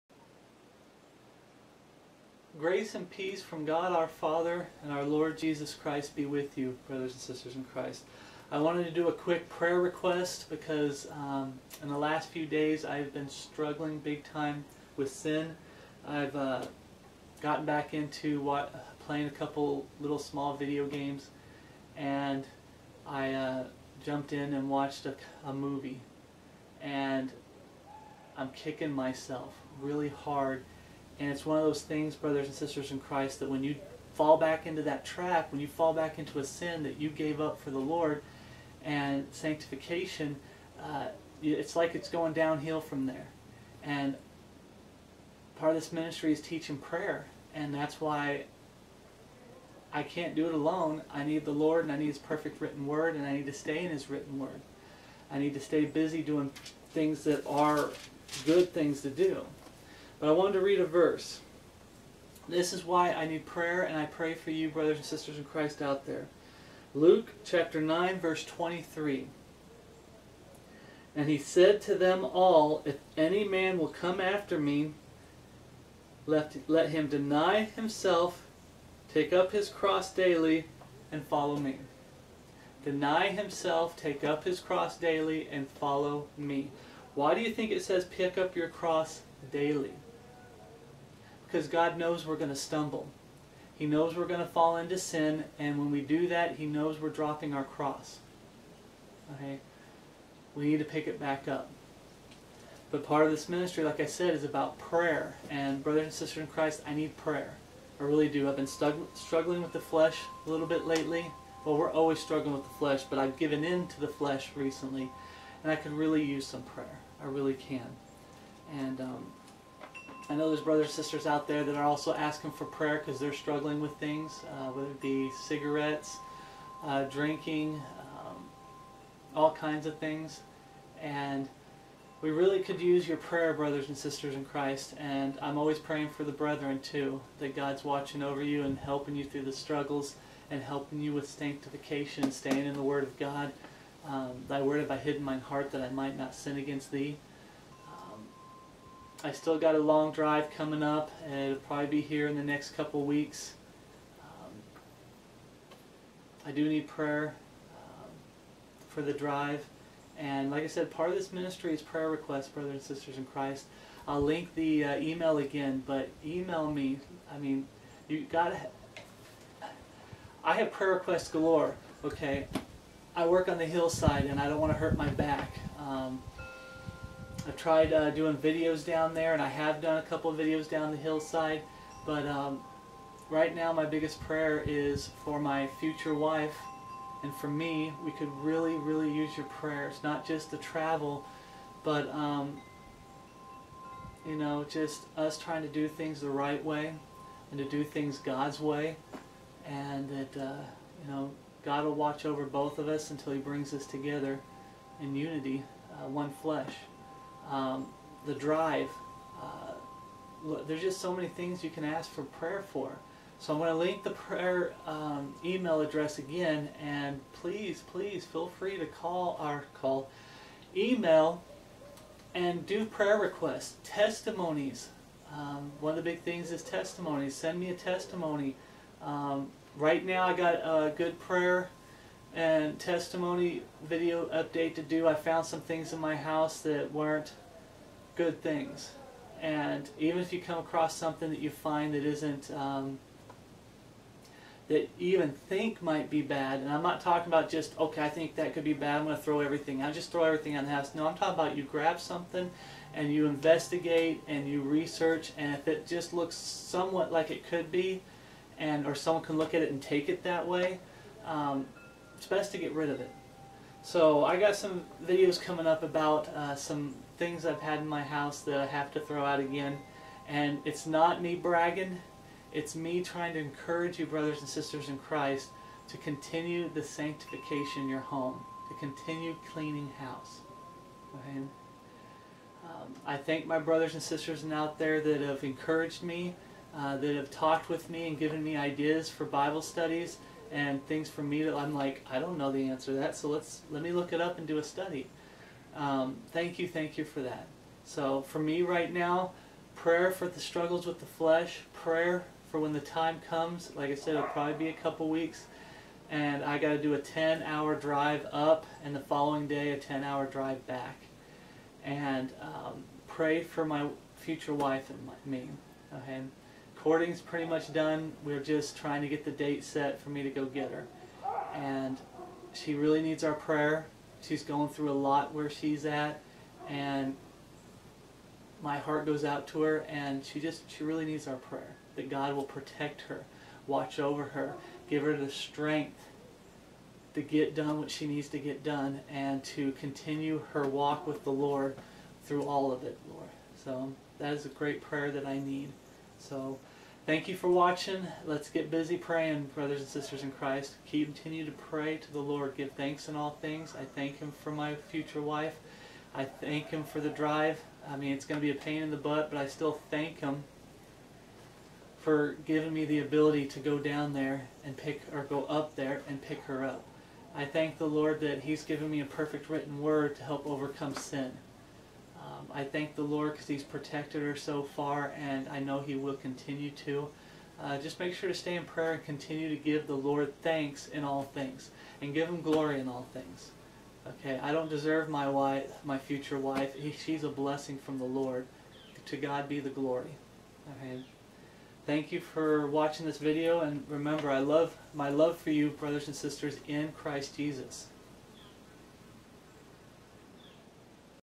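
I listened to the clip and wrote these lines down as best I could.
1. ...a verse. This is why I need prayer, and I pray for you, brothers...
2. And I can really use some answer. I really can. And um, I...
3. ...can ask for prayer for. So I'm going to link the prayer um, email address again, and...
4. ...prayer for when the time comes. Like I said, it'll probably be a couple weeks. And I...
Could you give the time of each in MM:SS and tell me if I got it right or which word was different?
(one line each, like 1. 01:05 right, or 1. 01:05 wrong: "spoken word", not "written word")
1. 01:00 right
2. 01:55 wrong: "prayer", not "answer"
3. 03:31 right
4. 05:01 right.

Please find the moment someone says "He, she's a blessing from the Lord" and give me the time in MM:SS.
06:26.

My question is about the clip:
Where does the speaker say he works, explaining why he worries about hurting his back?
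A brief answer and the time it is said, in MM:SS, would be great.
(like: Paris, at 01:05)
On the hillside, at 02:53.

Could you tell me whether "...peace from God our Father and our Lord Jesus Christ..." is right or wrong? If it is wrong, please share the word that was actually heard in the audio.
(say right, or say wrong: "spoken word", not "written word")
right.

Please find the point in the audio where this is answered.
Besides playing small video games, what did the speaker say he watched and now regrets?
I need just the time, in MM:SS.
00:25.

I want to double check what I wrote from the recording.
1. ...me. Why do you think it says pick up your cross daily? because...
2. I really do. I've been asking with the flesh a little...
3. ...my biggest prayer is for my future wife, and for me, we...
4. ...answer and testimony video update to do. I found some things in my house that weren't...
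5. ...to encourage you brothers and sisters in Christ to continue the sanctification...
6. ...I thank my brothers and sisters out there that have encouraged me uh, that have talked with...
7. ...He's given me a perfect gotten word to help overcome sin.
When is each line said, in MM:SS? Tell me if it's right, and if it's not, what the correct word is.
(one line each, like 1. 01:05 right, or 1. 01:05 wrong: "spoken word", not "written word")
1. 01:26 right
2. 01:47 wrong: "struggling", not "asking"
3. 03:03 right
4. 03:51 wrong: "prayer", not "answer"
5. 04:33 right
6. 04:43 right
7. 06:08 wrong: "written", not "gotten".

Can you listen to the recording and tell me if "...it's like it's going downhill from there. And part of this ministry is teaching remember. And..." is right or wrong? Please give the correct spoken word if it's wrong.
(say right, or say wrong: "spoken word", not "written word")
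wrong: "prayer", not "remember".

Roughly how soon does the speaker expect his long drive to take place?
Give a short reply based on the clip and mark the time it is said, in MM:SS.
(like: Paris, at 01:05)
Next couple weeks, at 02:32.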